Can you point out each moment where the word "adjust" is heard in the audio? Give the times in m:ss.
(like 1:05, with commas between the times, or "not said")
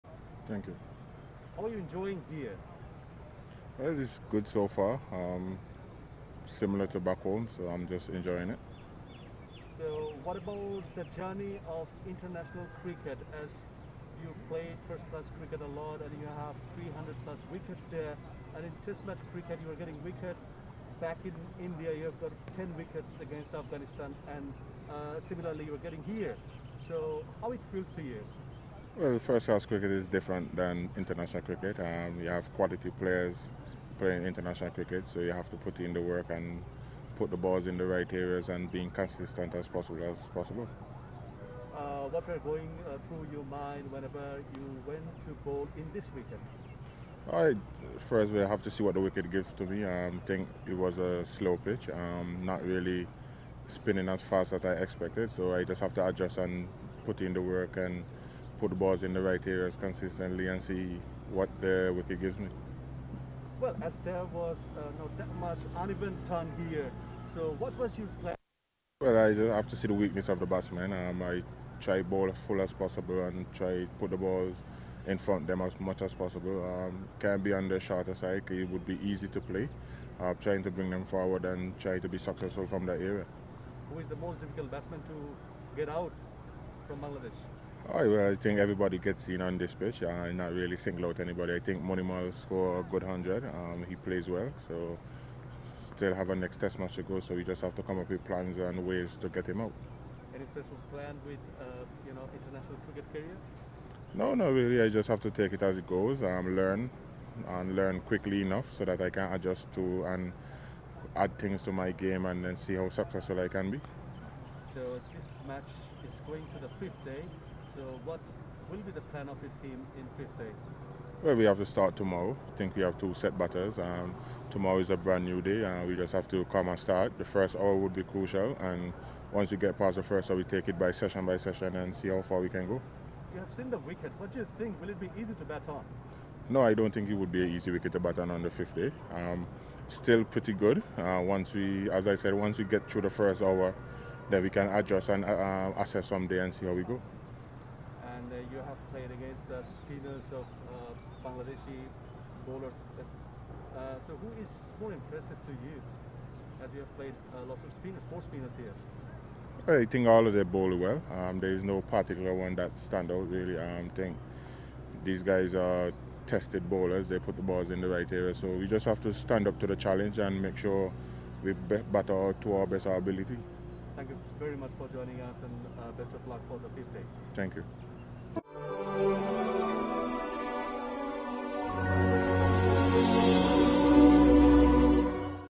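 0:56, 1:49, 2:24.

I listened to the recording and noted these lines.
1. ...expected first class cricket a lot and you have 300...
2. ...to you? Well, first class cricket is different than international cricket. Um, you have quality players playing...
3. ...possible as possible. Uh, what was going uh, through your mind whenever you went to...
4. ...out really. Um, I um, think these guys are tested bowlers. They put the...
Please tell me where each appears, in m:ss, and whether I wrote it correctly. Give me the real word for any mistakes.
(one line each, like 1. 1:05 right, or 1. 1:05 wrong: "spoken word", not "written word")
1. 0:14 wrong: "played", not "expected"
2. 0:27 right
3. 0:39 right
4. 2:43 right.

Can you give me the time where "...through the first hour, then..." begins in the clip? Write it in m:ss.
2:22.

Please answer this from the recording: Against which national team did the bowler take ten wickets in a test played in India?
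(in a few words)
Afghanistan.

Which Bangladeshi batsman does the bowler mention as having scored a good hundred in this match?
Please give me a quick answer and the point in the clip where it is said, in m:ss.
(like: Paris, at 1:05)
Mominul, at 1:31.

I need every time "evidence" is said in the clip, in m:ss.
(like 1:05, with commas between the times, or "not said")
not said.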